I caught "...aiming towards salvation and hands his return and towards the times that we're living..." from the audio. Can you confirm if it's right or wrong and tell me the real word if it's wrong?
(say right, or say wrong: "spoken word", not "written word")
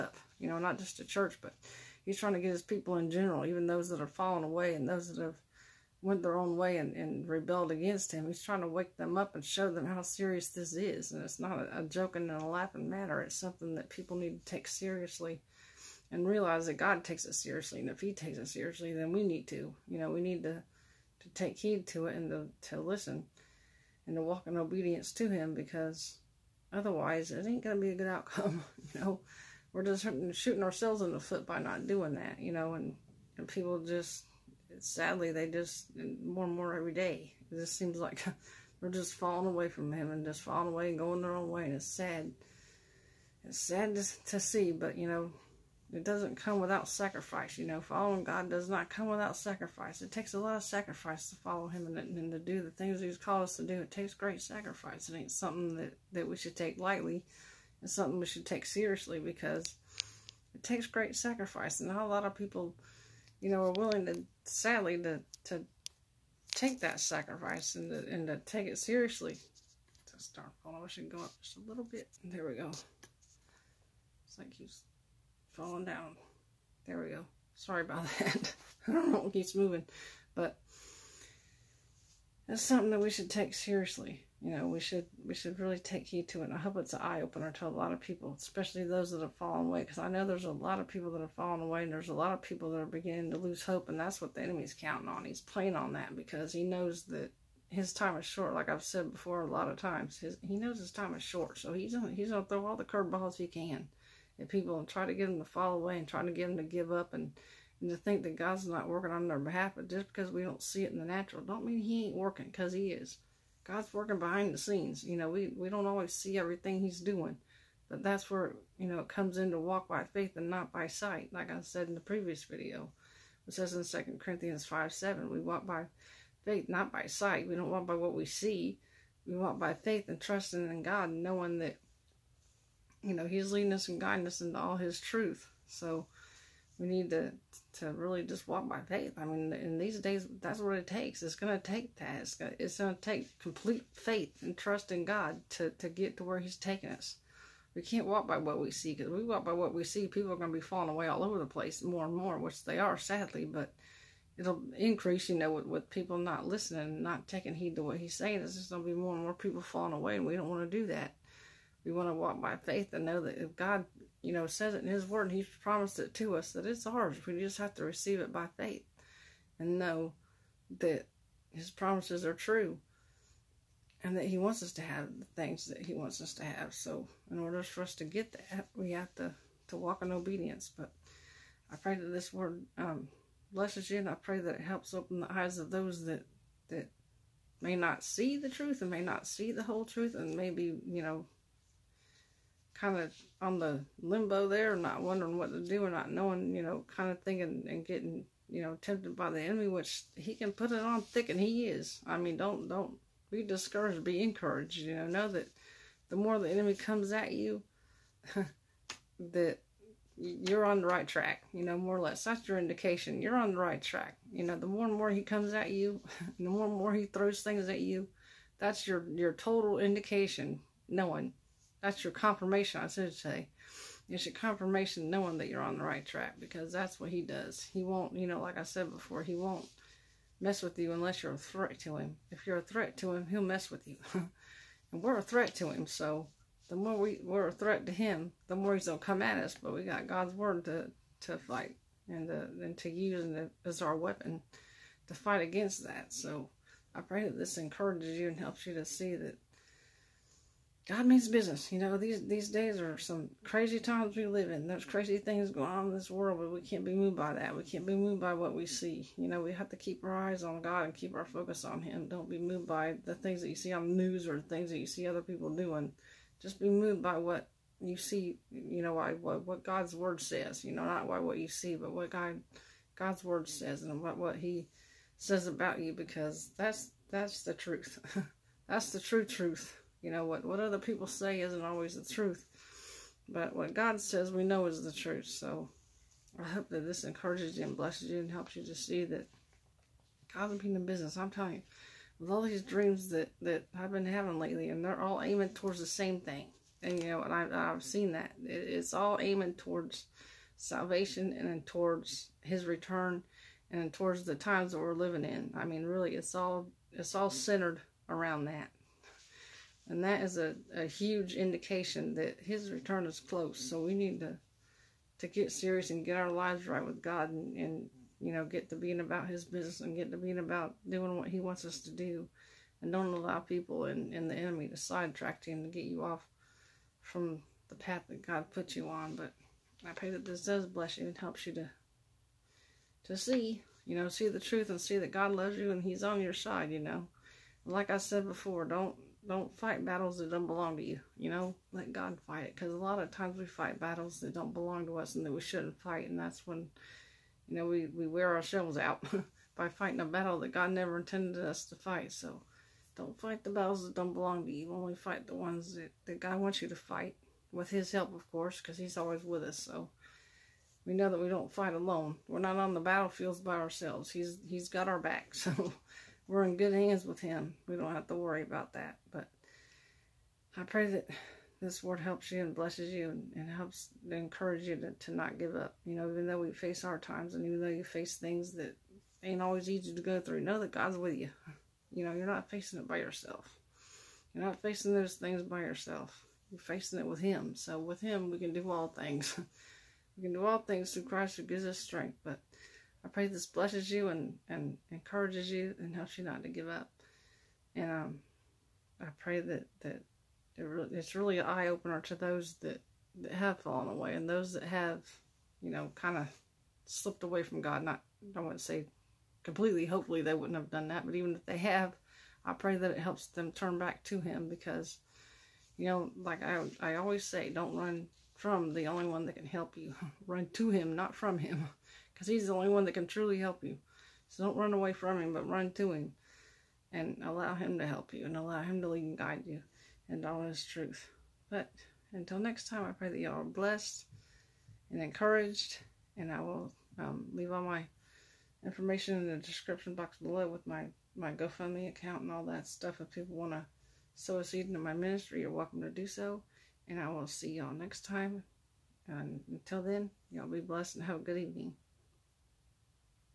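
wrong: "towards", not "hands".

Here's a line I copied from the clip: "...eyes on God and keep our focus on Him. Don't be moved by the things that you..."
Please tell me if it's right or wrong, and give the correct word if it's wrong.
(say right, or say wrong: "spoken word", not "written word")
right.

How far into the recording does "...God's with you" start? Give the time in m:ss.
6:20.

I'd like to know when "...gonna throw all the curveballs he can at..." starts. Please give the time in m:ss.
1:42.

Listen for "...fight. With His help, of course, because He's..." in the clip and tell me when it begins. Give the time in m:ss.
5:56.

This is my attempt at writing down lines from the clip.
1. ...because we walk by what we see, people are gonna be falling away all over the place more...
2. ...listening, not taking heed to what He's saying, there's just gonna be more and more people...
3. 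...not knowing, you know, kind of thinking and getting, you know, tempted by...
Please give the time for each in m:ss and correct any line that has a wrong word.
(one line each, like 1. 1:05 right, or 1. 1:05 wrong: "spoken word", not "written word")
1. 2:28 right
2. 2:36 right
3. 3:15 right.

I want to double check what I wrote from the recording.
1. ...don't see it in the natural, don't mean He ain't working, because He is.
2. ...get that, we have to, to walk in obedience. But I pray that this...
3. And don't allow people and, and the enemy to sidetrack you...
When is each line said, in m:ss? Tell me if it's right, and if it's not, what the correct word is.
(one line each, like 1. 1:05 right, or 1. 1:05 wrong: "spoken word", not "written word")
1. 1:50 right
2. 2:58 right
3. 5:22 right.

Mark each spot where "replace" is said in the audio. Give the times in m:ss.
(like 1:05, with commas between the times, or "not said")
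not said.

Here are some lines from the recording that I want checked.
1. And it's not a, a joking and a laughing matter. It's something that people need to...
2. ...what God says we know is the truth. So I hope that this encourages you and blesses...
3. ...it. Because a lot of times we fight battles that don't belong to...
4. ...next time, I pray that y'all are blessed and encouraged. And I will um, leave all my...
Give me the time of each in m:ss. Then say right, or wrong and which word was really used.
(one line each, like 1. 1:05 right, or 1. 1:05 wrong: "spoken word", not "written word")
1. 0:11 right
2. 4:43 right
3. 5:42 right
4. 7:12 right.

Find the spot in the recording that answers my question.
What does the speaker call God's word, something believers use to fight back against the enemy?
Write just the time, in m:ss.
4:03.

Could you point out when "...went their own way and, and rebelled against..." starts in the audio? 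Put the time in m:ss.
0:06.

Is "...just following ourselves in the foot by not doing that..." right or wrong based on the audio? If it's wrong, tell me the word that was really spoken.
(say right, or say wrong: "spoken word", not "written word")
wrong: "shooting", not "following".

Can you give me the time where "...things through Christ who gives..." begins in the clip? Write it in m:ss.
6:30.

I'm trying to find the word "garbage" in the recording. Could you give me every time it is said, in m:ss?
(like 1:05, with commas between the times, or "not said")
not said.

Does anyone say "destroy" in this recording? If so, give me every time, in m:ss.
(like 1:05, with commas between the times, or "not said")
not said.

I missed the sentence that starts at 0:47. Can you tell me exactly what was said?
You know, following God does not come without sacrifice.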